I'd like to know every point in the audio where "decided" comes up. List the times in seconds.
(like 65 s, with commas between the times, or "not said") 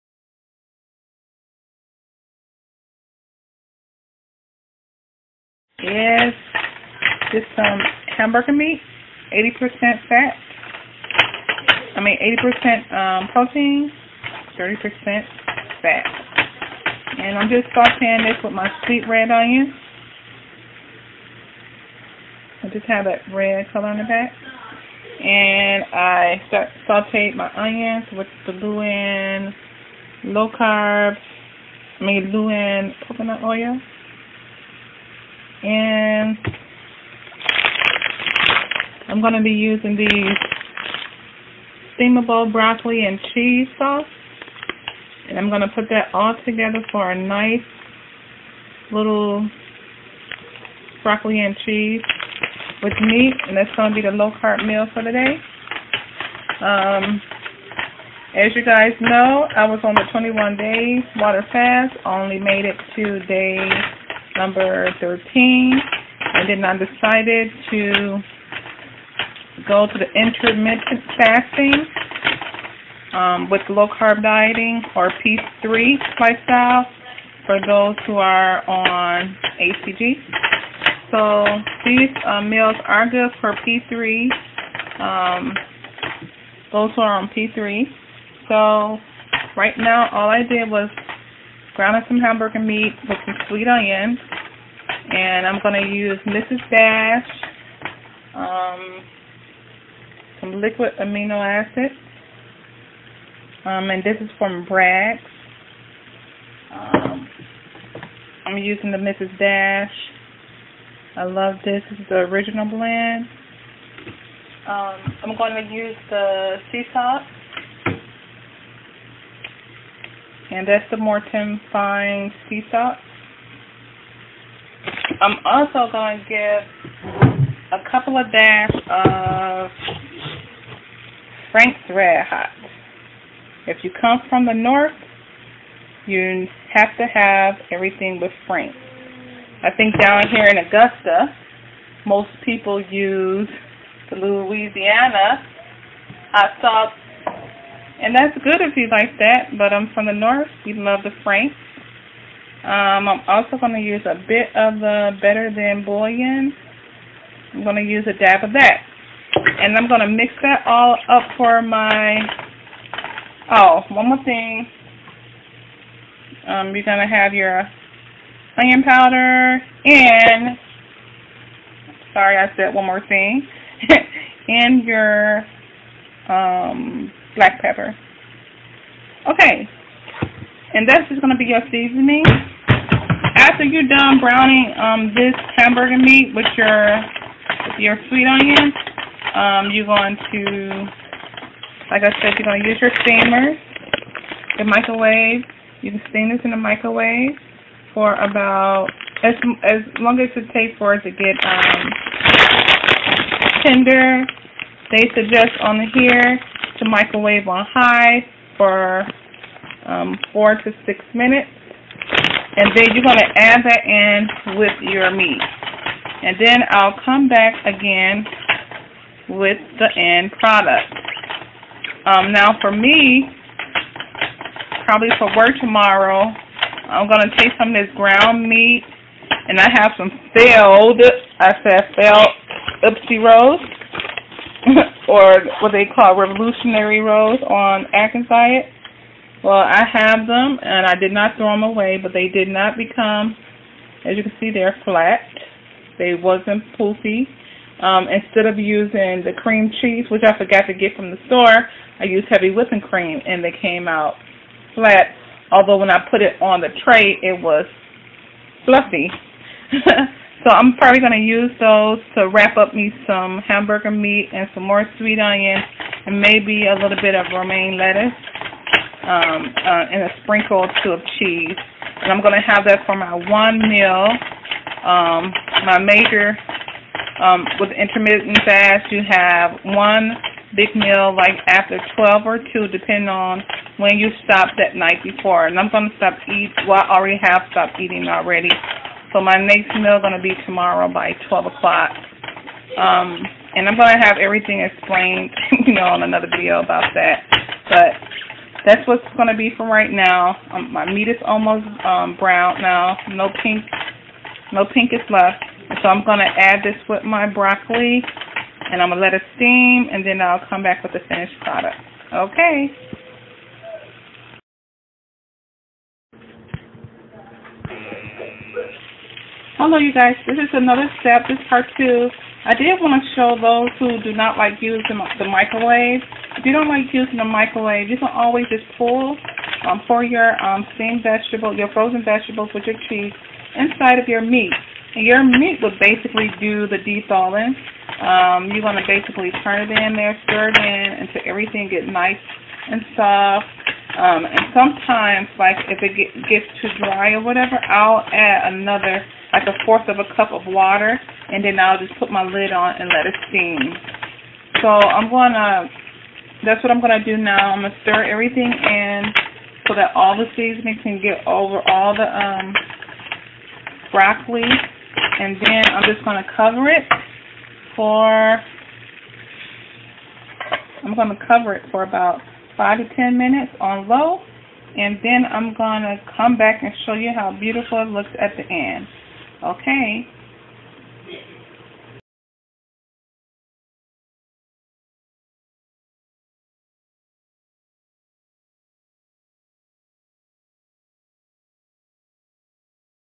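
66 s.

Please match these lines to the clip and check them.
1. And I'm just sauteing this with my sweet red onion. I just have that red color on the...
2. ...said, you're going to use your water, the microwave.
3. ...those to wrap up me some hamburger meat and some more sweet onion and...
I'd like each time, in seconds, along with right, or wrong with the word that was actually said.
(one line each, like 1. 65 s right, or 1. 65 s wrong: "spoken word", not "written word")
1. 17 s right
2. 192 s wrong: "steamer", not "water"
3. 261 s right.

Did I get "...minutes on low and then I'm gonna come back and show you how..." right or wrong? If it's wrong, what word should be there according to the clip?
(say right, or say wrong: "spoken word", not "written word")
right.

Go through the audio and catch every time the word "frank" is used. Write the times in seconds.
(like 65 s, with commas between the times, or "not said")
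131 s, 138 s, 151 s.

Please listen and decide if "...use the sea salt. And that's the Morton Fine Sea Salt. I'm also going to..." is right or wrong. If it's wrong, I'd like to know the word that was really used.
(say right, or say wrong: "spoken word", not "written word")
right.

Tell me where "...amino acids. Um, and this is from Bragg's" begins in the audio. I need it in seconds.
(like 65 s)
100 s.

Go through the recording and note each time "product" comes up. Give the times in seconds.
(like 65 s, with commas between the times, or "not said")
220 s, 311 s.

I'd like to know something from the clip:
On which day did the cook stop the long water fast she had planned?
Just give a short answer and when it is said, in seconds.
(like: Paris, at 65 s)
13, at 63 s.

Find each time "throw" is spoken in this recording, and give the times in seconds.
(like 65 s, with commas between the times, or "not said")
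241 s.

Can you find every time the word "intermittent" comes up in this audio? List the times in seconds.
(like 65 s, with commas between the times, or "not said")
70 s, 277 s.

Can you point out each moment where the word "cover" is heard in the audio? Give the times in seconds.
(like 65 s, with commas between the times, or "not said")
366 s, 371 s.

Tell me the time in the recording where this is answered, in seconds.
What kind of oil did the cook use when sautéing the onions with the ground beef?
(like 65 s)
33 s.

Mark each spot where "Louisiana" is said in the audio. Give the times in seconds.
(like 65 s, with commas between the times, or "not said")
144 s.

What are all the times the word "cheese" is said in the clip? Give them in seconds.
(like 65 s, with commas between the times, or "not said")
43 s, 51 s, 249 s, 271 s, 332 s.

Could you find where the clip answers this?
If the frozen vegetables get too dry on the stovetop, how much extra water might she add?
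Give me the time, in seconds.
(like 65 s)
349 s.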